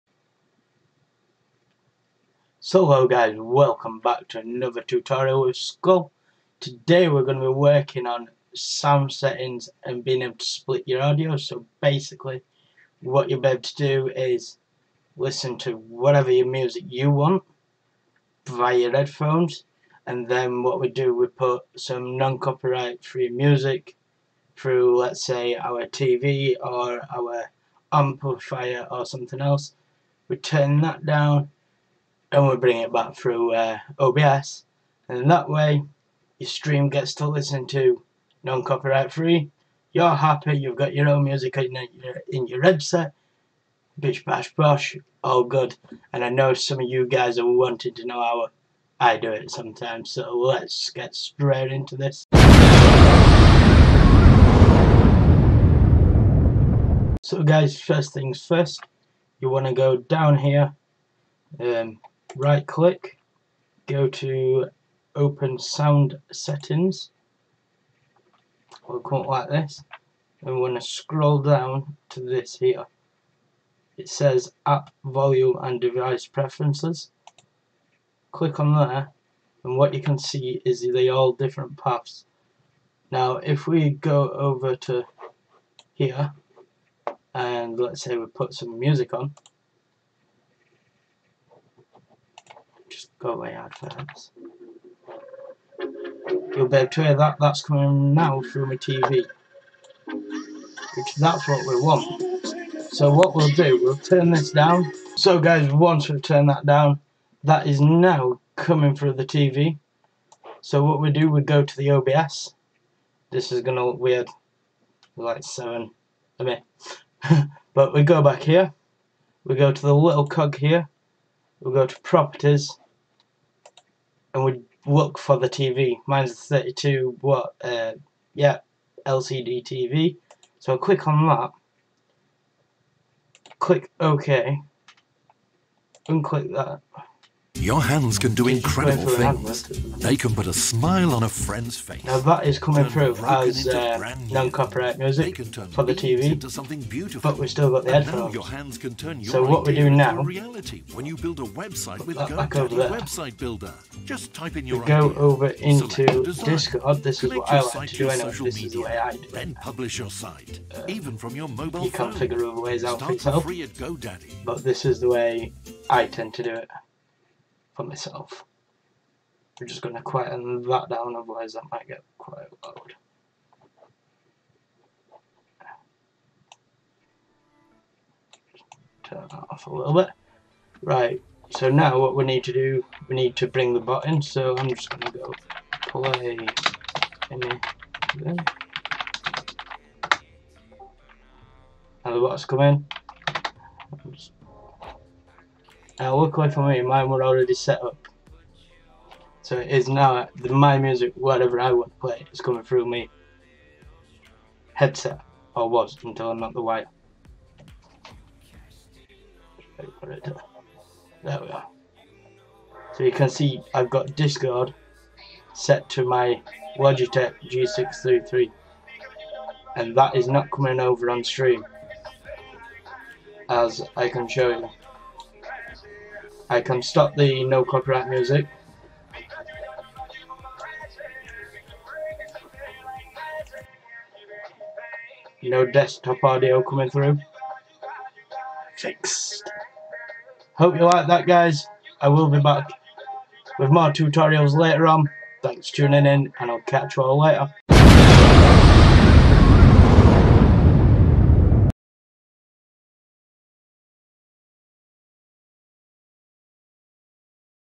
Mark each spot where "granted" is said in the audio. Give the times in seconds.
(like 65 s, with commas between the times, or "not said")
not said.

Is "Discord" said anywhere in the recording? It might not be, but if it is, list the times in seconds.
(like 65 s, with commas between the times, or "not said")
156 s, 214 s.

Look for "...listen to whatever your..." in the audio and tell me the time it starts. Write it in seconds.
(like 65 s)
15 s.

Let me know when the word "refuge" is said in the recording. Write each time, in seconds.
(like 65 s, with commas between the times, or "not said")
not said.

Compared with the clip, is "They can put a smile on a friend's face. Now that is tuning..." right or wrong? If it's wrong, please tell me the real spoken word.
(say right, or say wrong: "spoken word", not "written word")
wrong: "coming", not "tuning".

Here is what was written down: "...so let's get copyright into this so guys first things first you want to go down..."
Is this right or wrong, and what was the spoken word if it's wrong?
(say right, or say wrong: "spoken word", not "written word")
wrong: "straight", not "copyright".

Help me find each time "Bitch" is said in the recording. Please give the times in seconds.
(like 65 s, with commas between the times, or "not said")
43 s.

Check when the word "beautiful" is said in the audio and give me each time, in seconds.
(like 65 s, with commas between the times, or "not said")
146 s.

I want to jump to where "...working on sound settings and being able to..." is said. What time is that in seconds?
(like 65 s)
7 s.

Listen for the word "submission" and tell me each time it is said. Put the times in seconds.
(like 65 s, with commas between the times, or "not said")
not said.